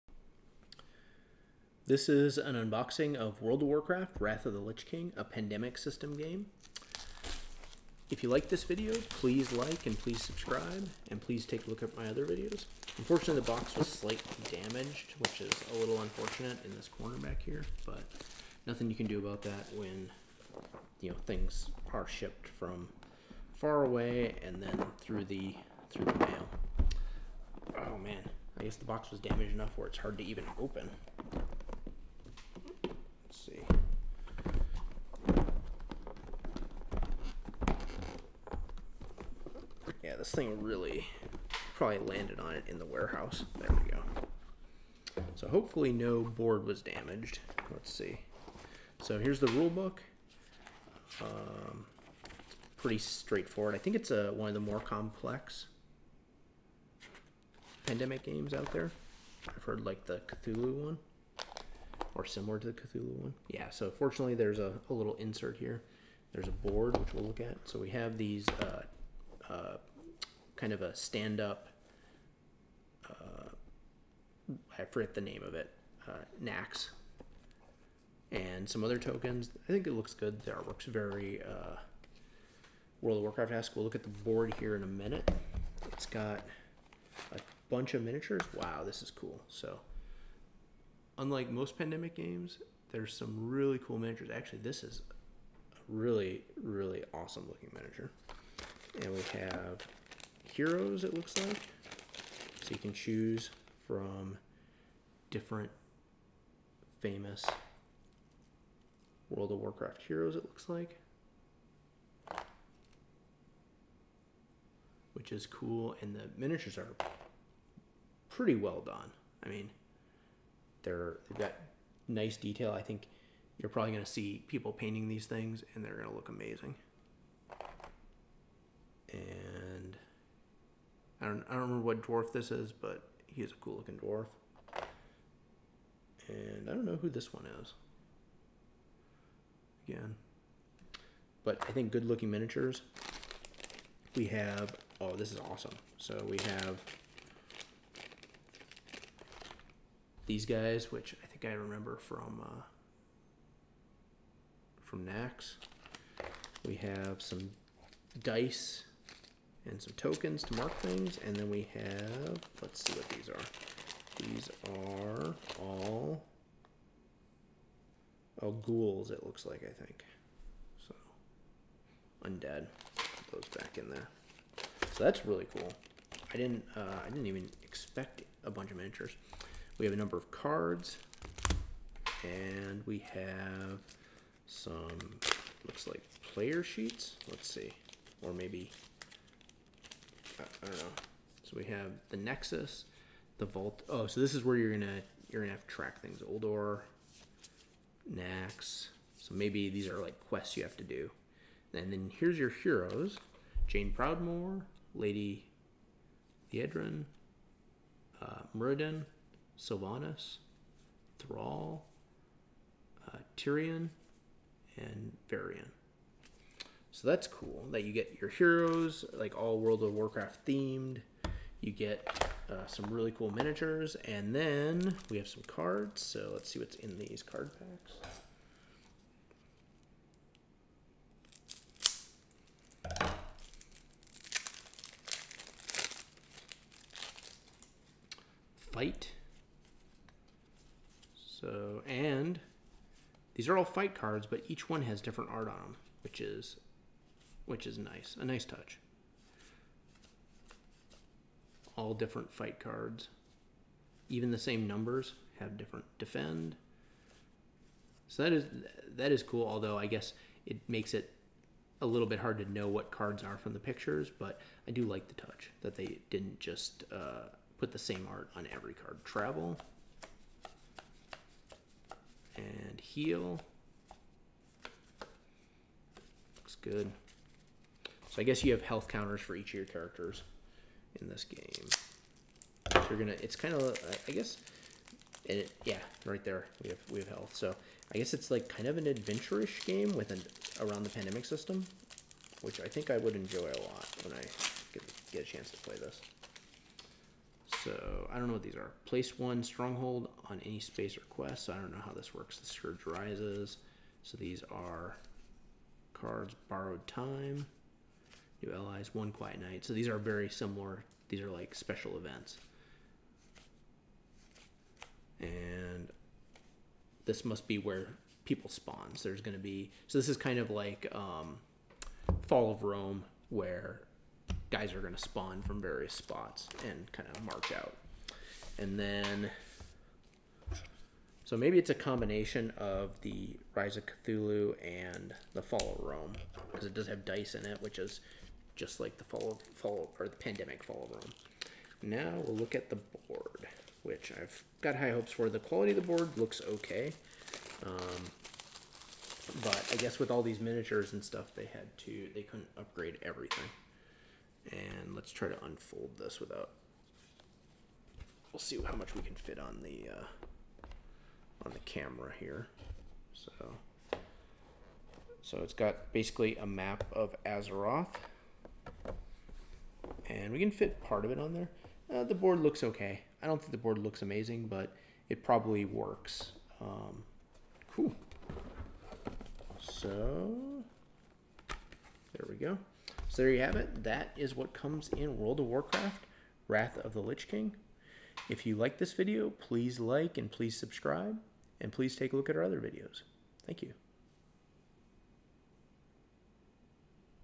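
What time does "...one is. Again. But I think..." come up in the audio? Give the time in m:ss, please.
2:17.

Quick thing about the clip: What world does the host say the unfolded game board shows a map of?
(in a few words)
Azeroth.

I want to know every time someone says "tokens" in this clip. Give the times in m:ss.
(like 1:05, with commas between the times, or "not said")
1:18, 2:39.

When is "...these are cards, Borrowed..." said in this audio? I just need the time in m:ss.
5:04.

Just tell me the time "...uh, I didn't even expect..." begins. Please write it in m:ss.
2:56.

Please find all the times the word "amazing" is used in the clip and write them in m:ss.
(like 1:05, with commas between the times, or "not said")
2:06, 6:14.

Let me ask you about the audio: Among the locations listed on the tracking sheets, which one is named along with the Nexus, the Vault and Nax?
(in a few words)
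Ulduar.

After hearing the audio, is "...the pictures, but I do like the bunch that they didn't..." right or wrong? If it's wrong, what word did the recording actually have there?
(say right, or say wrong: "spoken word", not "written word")
wrong: "touch", not "bunch".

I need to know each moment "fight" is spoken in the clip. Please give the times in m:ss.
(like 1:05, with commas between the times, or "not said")
3:58, 4:03, 4:12.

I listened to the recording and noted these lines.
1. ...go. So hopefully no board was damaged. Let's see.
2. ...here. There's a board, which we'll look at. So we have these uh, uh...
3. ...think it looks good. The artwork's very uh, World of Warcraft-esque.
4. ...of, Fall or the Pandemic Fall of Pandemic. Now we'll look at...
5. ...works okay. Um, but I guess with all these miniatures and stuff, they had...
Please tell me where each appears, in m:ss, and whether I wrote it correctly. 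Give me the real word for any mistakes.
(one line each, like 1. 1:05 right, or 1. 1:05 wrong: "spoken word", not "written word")
1. 0:43 right
2. 1:05 right
3. 1:19 right
4. 5:39 wrong: "Rome", not "Pandemic"
5. 5:46 wrong: "looks", not "works".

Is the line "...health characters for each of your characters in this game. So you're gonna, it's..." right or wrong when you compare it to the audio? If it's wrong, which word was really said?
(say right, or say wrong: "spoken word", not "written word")
wrong: "counters", not "characters".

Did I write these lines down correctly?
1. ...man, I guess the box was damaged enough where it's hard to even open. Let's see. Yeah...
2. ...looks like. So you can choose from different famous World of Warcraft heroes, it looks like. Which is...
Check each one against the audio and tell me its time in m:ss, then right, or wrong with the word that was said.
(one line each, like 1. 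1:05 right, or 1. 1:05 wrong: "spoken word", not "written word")
1. 0:27 right
2. 1:41 right.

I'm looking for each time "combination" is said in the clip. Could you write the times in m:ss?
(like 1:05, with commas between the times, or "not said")
5:31.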